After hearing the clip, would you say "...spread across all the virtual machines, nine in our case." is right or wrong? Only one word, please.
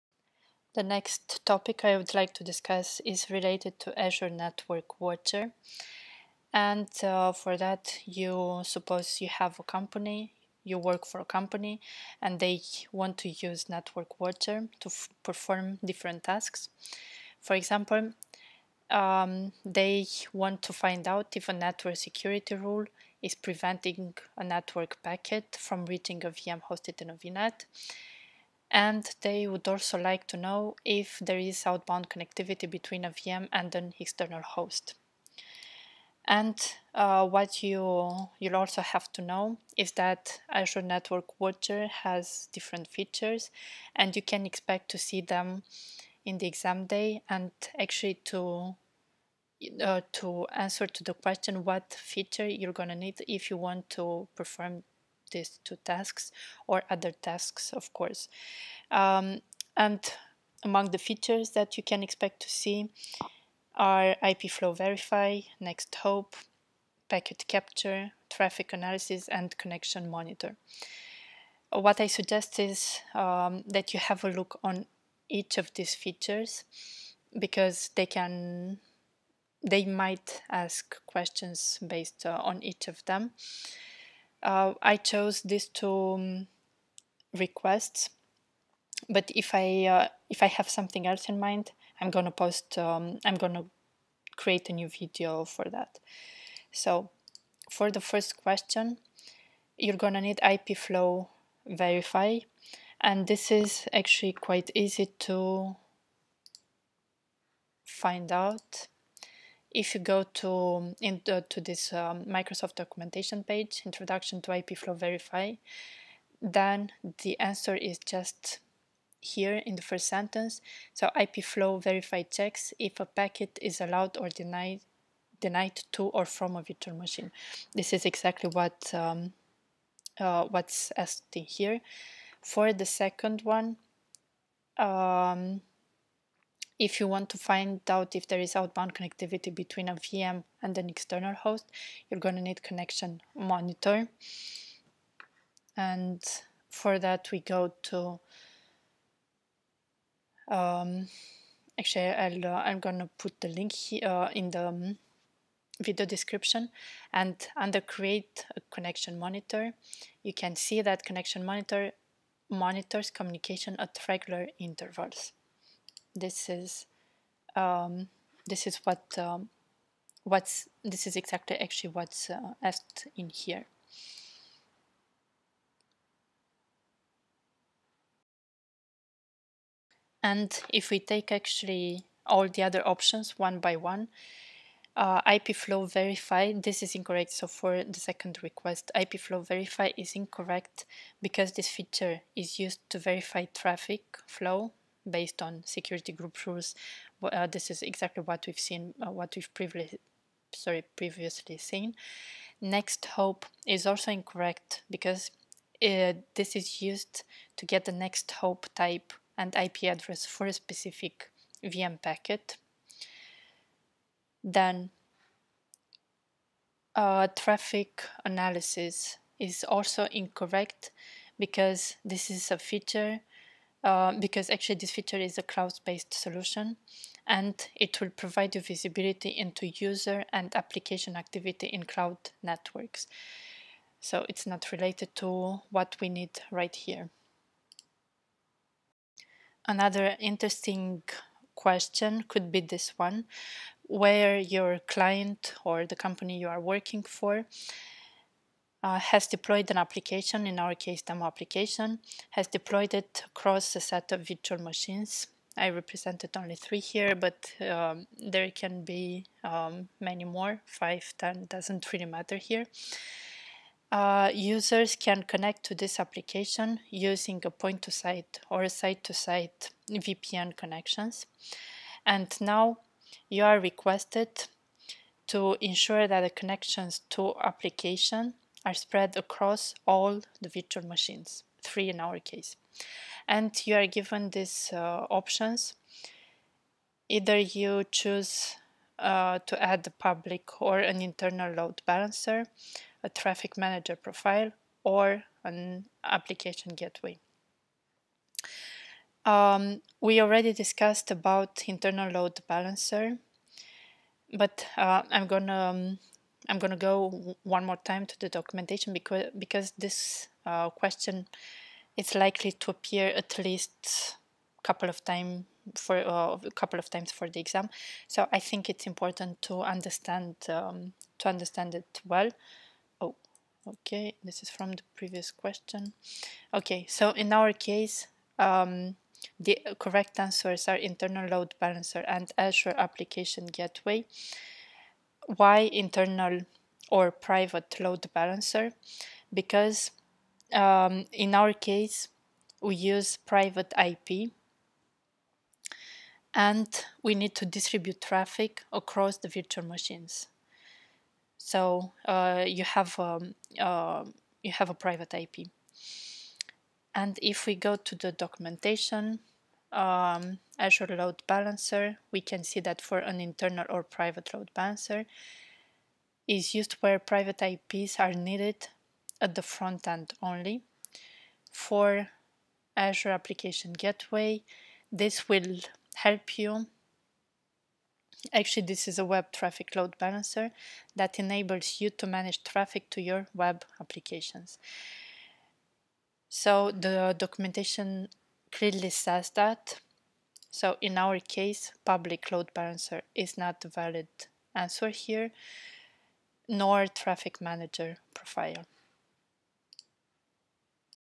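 wrong.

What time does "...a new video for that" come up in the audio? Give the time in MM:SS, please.
01:34.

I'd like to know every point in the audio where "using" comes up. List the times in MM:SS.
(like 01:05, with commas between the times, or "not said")
04:26.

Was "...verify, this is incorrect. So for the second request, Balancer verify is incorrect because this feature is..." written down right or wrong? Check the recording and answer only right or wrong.
wrong.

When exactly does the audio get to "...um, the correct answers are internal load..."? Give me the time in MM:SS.
05:28.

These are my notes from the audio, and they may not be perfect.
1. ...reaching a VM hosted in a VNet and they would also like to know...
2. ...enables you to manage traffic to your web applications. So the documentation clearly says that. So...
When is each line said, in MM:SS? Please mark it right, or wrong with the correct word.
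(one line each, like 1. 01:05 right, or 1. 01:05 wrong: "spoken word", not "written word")
1. 00:25 right
2. 06:21 right.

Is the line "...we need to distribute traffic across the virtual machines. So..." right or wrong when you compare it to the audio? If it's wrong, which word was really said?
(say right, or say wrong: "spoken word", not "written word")
right.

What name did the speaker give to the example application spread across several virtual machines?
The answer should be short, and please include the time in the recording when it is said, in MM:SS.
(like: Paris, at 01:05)
demo application, at 04:11.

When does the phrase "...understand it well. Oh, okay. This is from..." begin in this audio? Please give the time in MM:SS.
05:21.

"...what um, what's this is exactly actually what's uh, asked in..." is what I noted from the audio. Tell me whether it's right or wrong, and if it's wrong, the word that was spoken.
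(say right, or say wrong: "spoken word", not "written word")
right.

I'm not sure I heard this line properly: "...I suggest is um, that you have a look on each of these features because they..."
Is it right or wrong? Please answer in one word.
right.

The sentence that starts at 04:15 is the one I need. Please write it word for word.
I represented only three here, but um, there can be um, many more, five, ten, doesn't really matter here.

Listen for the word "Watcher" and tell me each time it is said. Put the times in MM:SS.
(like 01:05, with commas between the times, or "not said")
00:05, 00:14, 00:41.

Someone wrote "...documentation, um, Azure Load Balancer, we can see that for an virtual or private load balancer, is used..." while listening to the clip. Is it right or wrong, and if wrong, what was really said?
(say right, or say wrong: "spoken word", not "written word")
wrong: "internal", not "virtual".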